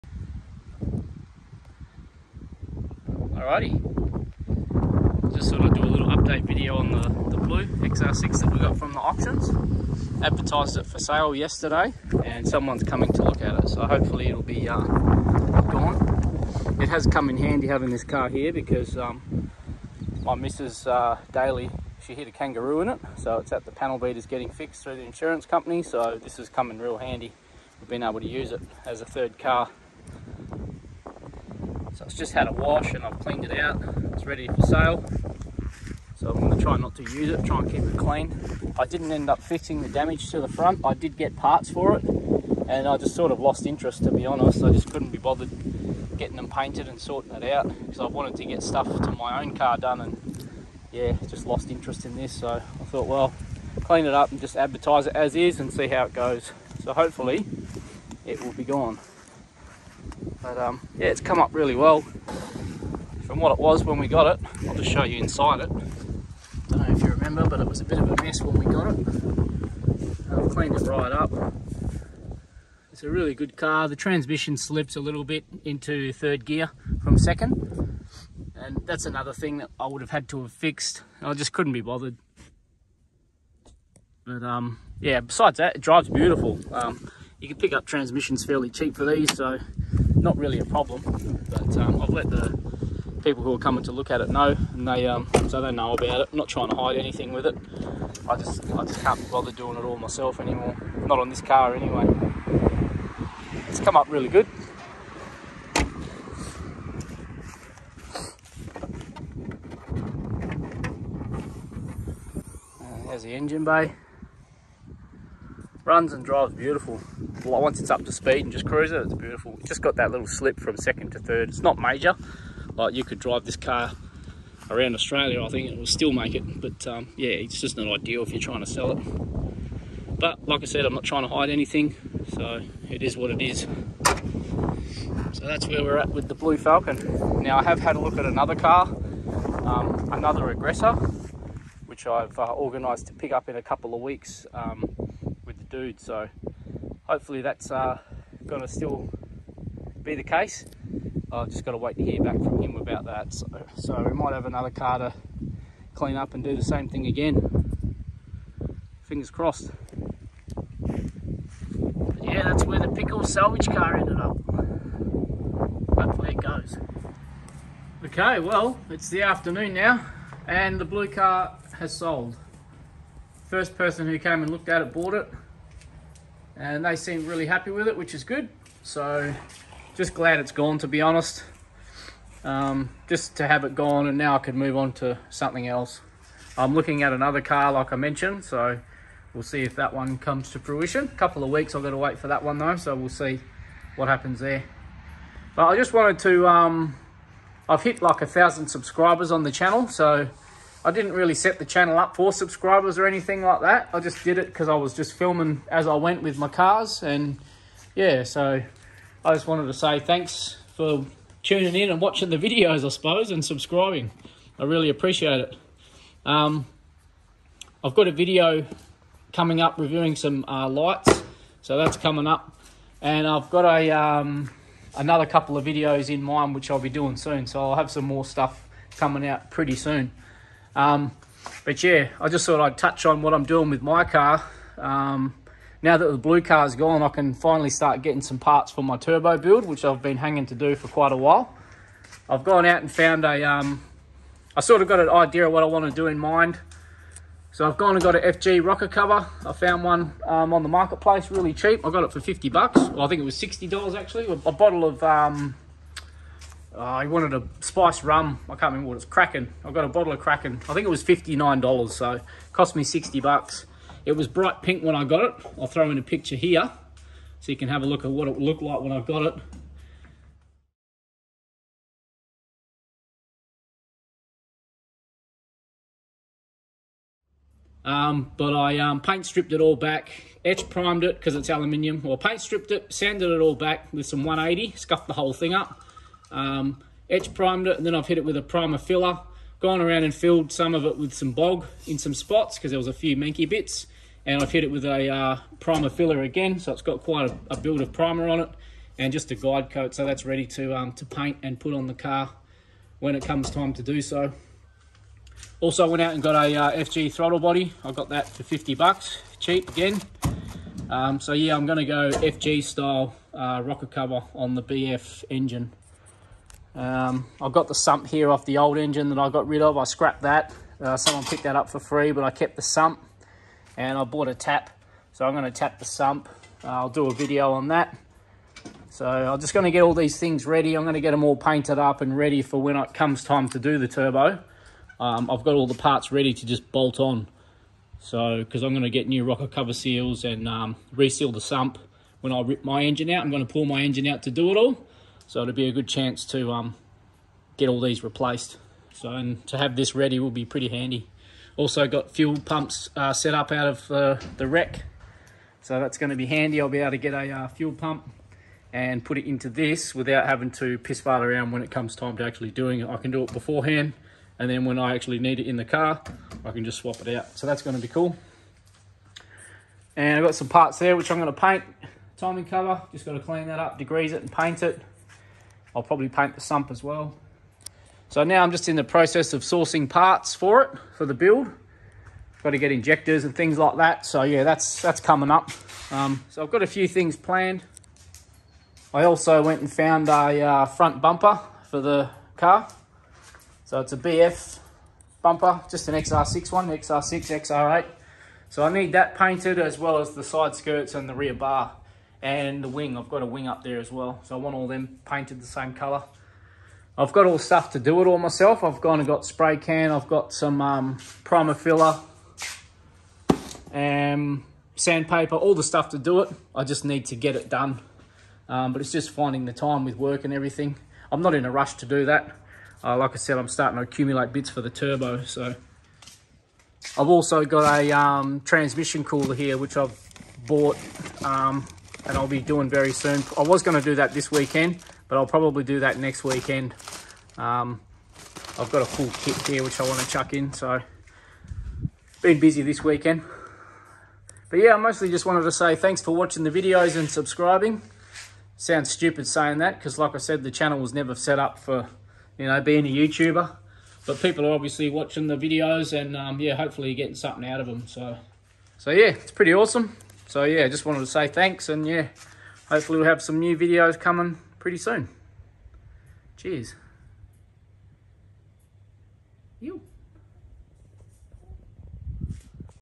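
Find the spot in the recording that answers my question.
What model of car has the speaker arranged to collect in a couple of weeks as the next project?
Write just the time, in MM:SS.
02:20.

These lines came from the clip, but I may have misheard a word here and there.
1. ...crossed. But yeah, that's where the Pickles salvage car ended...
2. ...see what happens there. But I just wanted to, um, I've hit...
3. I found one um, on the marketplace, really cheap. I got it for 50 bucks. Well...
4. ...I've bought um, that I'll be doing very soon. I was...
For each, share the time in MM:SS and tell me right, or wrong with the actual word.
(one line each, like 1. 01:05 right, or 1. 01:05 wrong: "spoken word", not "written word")
1. 02:39 right
2. 03:13 right
3. 04:09 right
4. 07:09 right.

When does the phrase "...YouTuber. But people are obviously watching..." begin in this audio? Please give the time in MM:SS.
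07:32.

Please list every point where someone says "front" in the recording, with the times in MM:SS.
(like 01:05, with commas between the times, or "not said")
00:40, 06:30.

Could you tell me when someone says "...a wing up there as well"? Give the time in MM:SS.
06:43.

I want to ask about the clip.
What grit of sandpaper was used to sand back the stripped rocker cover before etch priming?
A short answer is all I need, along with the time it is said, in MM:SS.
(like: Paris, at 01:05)
180, at 04:44.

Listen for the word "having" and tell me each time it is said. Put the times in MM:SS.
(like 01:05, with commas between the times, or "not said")
00:17, 06:00.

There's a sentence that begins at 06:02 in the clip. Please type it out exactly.
I can do it beforehand and then when I actually need it in the car, I can just swap it out.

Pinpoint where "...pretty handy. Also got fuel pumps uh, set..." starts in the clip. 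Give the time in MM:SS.
05:50.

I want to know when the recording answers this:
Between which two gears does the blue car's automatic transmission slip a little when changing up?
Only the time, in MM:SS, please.
02:00.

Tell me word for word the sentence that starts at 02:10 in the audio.
But like I said, I'm not trying to hide anything.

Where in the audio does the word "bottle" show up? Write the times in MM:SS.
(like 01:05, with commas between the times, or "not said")
04:14, 04:19.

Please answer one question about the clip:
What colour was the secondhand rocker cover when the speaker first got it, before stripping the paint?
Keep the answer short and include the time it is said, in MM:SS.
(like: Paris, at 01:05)
Bright pink, at 04:24.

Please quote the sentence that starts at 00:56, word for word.
So hopefully it will be gone.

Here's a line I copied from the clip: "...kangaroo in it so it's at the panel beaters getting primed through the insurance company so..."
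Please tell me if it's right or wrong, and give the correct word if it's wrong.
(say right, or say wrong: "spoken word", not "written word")
wrong: "fixed", not "primed".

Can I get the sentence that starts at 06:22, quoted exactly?
Got to get injectors and things like that.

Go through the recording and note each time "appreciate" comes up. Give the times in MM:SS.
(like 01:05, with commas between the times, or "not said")
03:34.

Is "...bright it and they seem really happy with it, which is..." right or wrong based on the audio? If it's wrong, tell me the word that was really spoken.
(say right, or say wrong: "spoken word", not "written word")
wrong: "bought", not "bright".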